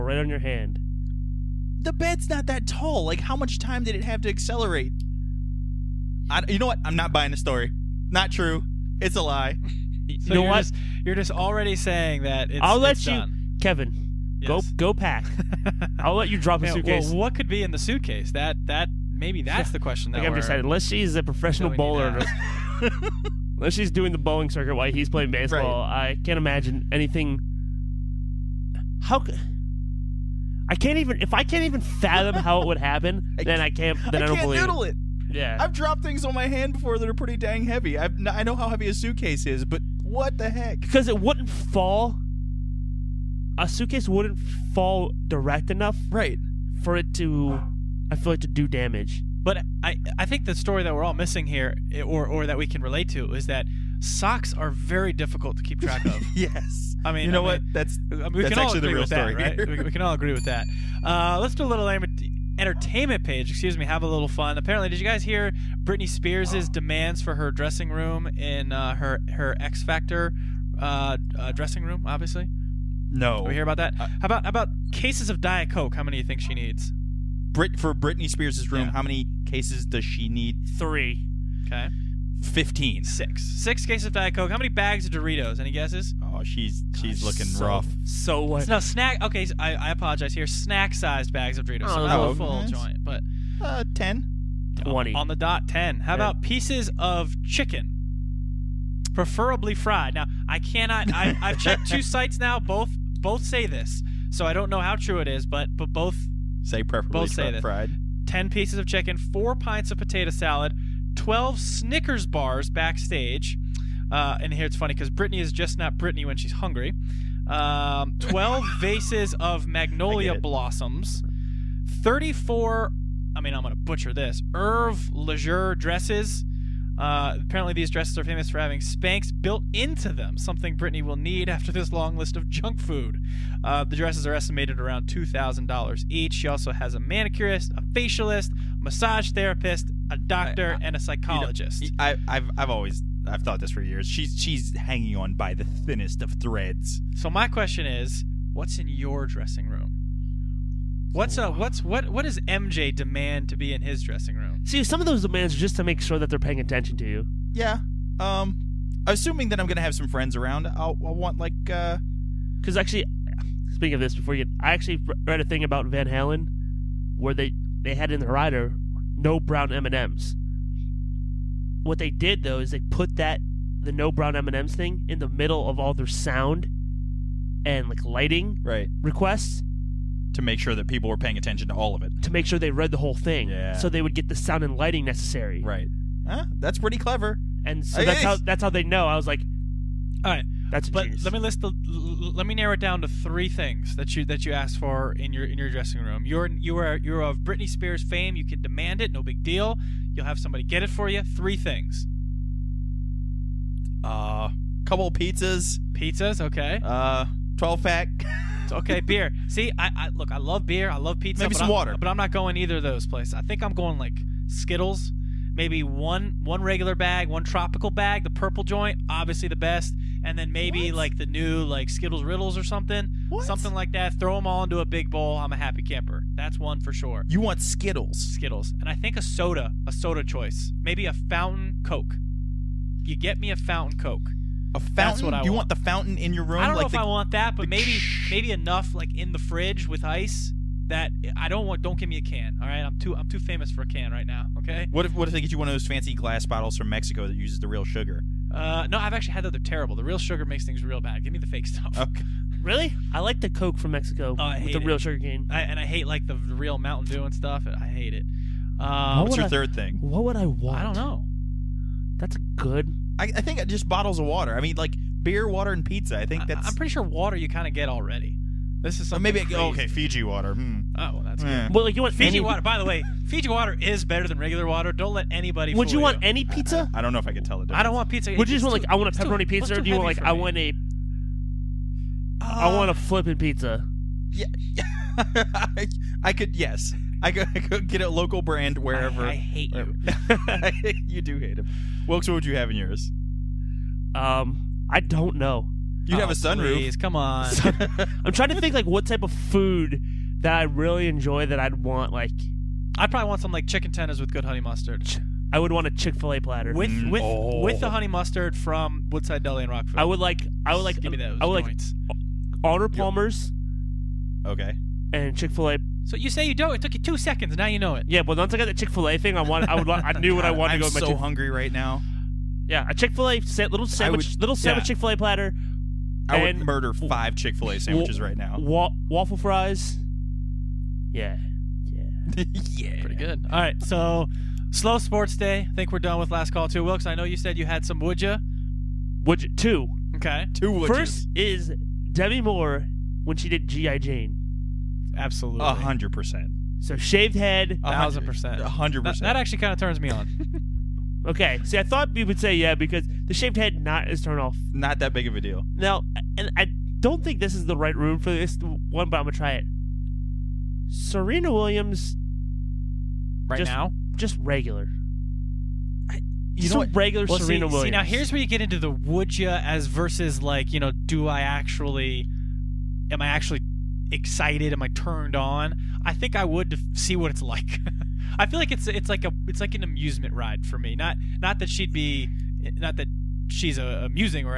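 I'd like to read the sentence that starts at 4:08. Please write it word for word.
Uh, no, I've actually had that.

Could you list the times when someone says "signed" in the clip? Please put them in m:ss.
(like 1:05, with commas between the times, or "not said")
not said.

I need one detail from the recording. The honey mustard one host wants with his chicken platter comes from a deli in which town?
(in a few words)
Rockford.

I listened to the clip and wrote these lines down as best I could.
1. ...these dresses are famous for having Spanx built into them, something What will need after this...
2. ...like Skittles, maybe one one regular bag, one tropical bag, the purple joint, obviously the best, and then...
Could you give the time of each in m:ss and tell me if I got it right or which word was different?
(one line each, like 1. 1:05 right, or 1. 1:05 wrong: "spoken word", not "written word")
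1. 2:07 wrong: "Britney", not "What"
2. 3:33 right.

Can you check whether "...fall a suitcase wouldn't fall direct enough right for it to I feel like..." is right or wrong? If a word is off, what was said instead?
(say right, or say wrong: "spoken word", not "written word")
right.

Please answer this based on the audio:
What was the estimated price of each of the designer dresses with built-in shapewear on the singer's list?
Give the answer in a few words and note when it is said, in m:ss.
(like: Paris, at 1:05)
$2,000, at 2:15.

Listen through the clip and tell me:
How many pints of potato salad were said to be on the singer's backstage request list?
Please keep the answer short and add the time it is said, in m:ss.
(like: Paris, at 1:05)
4, at 1:49.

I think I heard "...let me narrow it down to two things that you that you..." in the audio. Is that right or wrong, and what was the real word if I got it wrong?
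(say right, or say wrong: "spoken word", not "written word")
wrong: "three", not "two".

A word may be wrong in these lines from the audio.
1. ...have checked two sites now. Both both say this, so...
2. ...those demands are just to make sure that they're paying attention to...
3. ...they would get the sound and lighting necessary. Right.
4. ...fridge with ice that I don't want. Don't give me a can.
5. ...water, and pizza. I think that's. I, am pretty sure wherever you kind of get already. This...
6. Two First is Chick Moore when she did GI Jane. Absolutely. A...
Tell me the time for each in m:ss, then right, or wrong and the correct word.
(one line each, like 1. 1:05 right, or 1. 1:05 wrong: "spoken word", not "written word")
1. 1:41 right
2. 2:35 right
3. 3:03 right
4. 3:59 right
5. 4:25 wrong: "water", not "wherever"
6. 5:40 wrong: "Demi", not "Chick".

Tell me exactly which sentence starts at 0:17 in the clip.
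Well, what could be in the suitcase?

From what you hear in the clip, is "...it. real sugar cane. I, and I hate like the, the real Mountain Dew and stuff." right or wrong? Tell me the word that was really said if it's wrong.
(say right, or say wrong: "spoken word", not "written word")
right.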